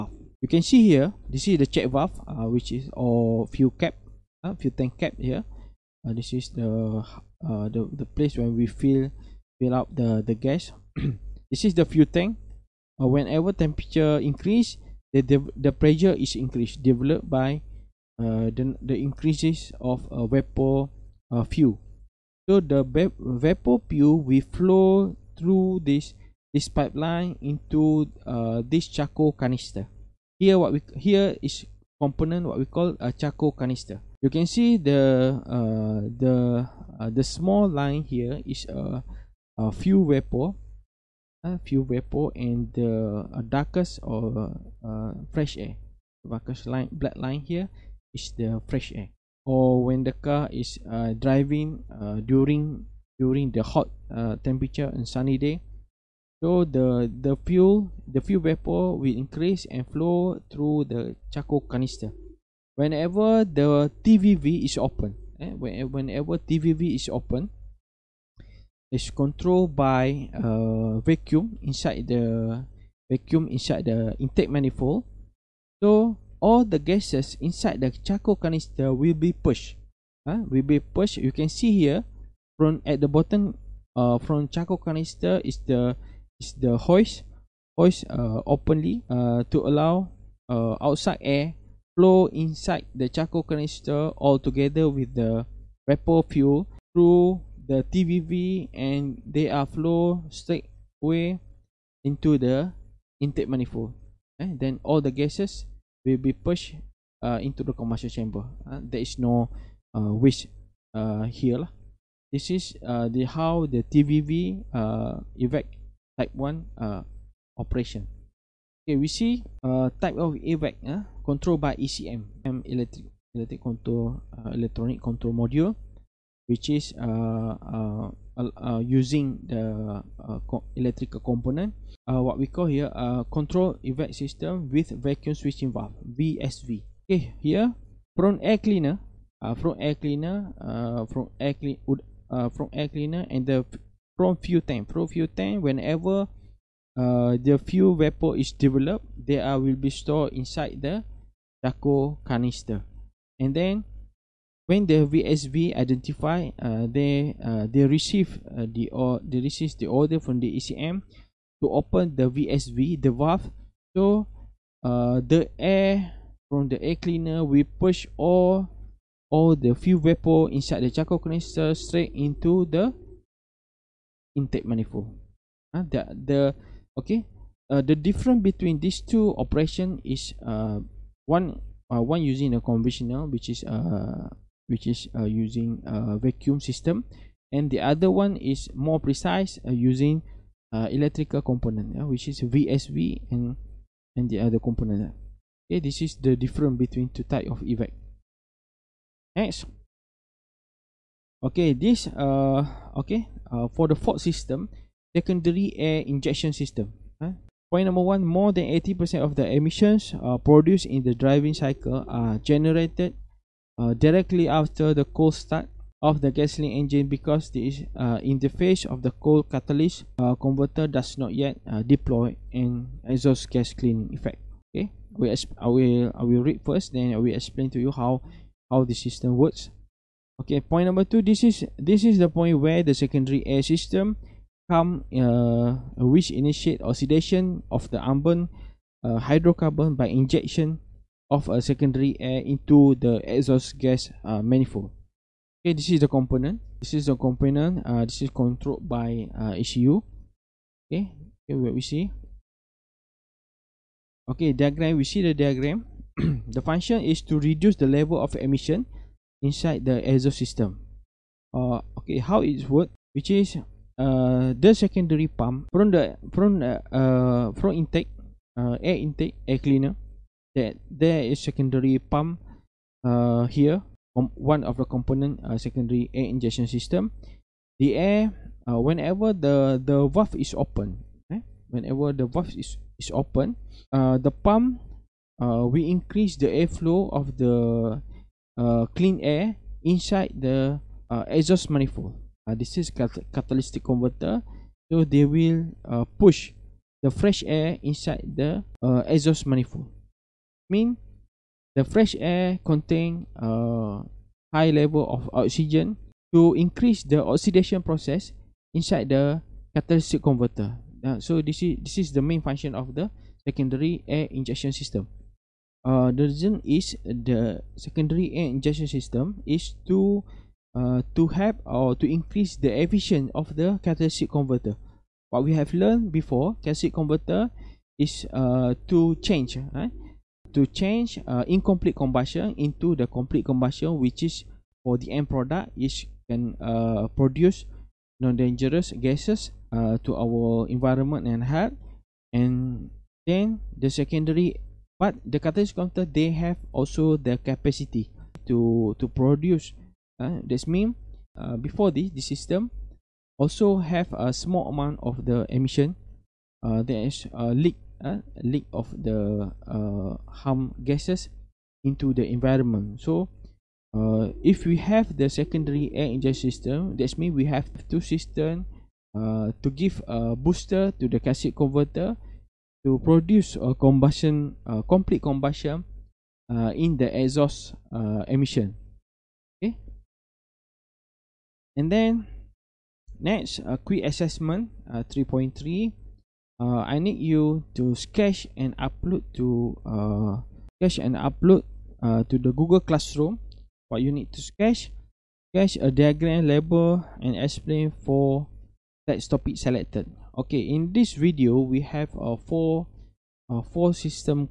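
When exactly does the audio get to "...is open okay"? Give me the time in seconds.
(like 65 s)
280 s.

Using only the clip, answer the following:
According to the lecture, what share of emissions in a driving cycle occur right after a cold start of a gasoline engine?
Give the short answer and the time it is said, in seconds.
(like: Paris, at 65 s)
more than 80 percent, at 208 s.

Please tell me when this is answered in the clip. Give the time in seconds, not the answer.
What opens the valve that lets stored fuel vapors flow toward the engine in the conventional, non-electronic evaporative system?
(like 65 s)
73 s.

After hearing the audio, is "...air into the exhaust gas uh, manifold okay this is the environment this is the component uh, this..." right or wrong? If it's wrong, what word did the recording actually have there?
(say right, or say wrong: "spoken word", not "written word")
wrong: "component", not "environment".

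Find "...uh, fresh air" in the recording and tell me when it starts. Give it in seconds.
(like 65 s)
44 s.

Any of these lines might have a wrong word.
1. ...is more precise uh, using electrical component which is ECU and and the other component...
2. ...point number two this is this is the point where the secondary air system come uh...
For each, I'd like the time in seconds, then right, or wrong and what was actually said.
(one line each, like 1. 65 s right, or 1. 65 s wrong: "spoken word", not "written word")
1. 188 s wrong: "VSV", not "ECU"
2. 230 s right.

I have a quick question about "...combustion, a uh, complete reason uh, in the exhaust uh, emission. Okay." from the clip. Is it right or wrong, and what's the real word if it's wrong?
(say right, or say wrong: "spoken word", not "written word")
wrong: "combustion", not "reason".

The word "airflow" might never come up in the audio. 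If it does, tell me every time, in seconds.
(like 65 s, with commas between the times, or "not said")
286 s.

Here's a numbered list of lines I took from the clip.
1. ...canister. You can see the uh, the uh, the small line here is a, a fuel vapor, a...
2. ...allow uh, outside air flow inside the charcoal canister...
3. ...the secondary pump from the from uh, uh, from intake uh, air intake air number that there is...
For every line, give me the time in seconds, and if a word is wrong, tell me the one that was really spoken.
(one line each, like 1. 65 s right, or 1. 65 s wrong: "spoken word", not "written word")
1. 33 s right
2. 89 s right
3. 264 s wrong: "cleaner", not "number".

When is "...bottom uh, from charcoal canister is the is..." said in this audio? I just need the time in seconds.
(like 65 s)
83 s.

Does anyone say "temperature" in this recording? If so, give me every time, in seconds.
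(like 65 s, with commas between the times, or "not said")
13 s, 54 s.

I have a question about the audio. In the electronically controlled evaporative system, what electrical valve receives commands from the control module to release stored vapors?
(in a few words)
vacuum switching valve.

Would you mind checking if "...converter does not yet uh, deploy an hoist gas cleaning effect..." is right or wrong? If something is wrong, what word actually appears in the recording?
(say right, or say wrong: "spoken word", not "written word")
wrong: "exhaust", not "hoist".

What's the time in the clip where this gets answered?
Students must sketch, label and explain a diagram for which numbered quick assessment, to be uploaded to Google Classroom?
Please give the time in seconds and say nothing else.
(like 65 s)
385 s.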